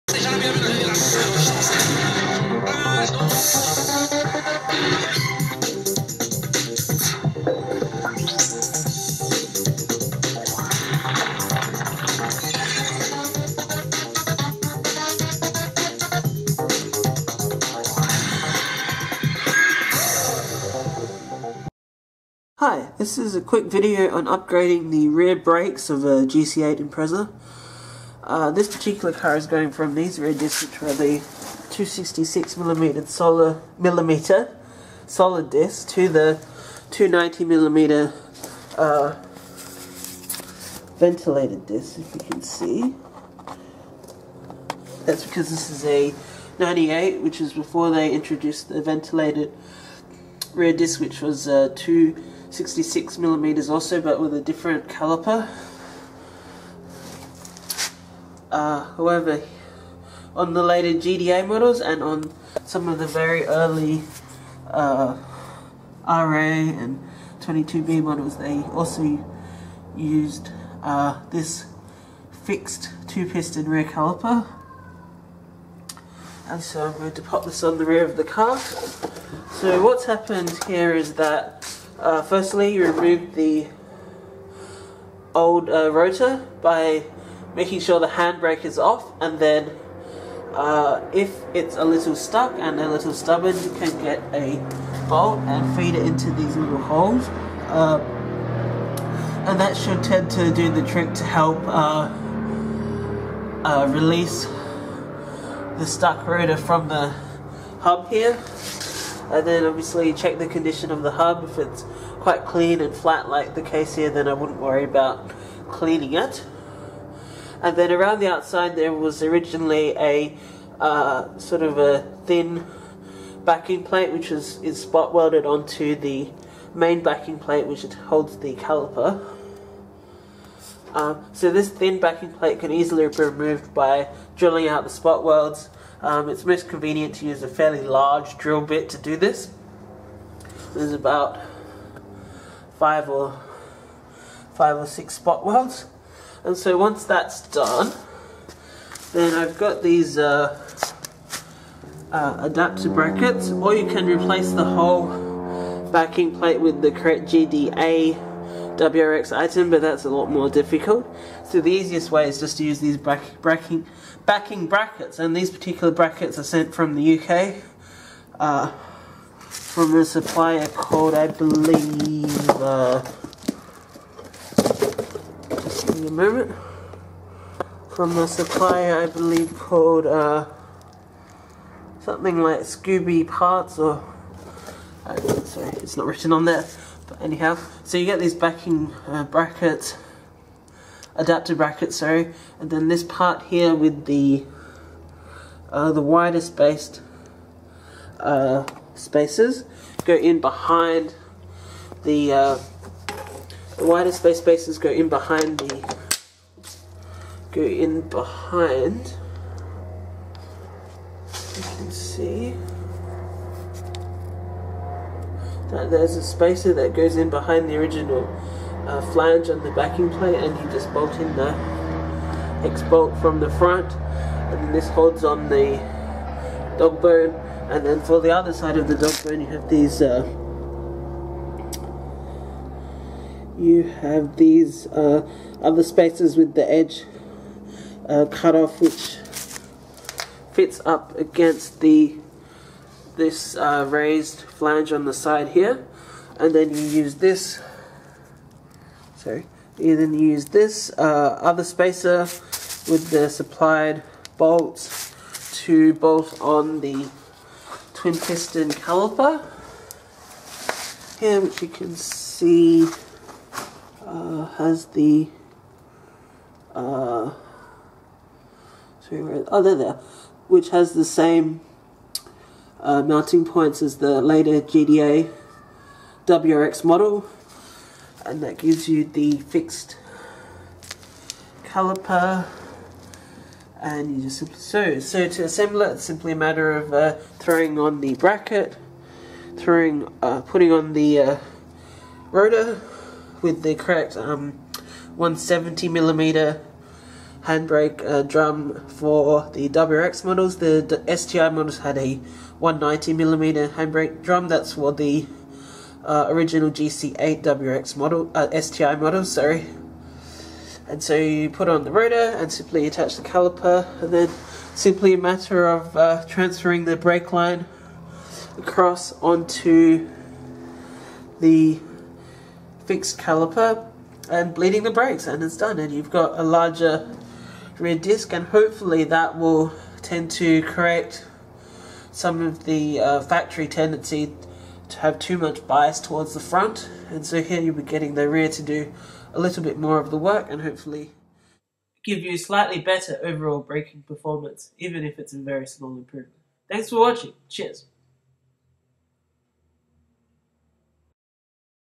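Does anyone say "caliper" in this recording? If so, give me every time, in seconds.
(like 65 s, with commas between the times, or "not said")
54 s, 73 s, 128 s, 258 s, 281 s, 313 s, 323 s.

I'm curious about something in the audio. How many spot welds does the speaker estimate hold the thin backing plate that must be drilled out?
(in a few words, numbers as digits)
5 or 6.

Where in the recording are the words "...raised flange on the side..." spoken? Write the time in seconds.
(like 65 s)
243 s.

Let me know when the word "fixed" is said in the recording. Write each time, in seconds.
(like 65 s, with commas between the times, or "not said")
72 s, 279 s, 322 s.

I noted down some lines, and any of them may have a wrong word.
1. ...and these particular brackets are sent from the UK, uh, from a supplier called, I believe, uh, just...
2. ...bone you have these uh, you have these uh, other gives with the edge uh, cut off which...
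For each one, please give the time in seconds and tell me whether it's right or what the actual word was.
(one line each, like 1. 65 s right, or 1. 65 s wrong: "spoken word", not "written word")
1. 165 s right
2. 229 s wrong: "spaces", not "gives".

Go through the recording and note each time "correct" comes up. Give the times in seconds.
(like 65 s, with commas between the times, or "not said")
156 s, 293 s, 330 s.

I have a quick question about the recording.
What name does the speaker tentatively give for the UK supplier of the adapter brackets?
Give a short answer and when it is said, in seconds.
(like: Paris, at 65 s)
Scooby Parts, at 182 s.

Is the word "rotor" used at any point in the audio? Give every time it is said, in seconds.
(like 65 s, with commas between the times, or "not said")
85 s, 106 s, 292 s, 311 s.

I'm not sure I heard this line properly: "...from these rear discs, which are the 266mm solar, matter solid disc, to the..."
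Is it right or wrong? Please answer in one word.
wrong.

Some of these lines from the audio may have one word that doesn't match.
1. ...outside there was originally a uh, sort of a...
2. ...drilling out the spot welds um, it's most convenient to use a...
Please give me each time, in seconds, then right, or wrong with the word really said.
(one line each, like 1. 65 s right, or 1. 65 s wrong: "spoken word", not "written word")
1. 118 s right
2. 134 s right.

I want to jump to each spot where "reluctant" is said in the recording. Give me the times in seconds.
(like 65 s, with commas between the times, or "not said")
not said.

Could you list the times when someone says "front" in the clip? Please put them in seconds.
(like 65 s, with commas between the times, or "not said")
223 s, 336 s.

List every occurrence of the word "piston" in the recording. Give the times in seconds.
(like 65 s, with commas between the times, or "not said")
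73 s, 258 s.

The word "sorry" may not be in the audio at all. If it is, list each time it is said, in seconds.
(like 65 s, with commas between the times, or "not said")
185 s, 191 s, 269 s, 309 s.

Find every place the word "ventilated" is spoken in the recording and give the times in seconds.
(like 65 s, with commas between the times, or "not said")
40 s, 48 s.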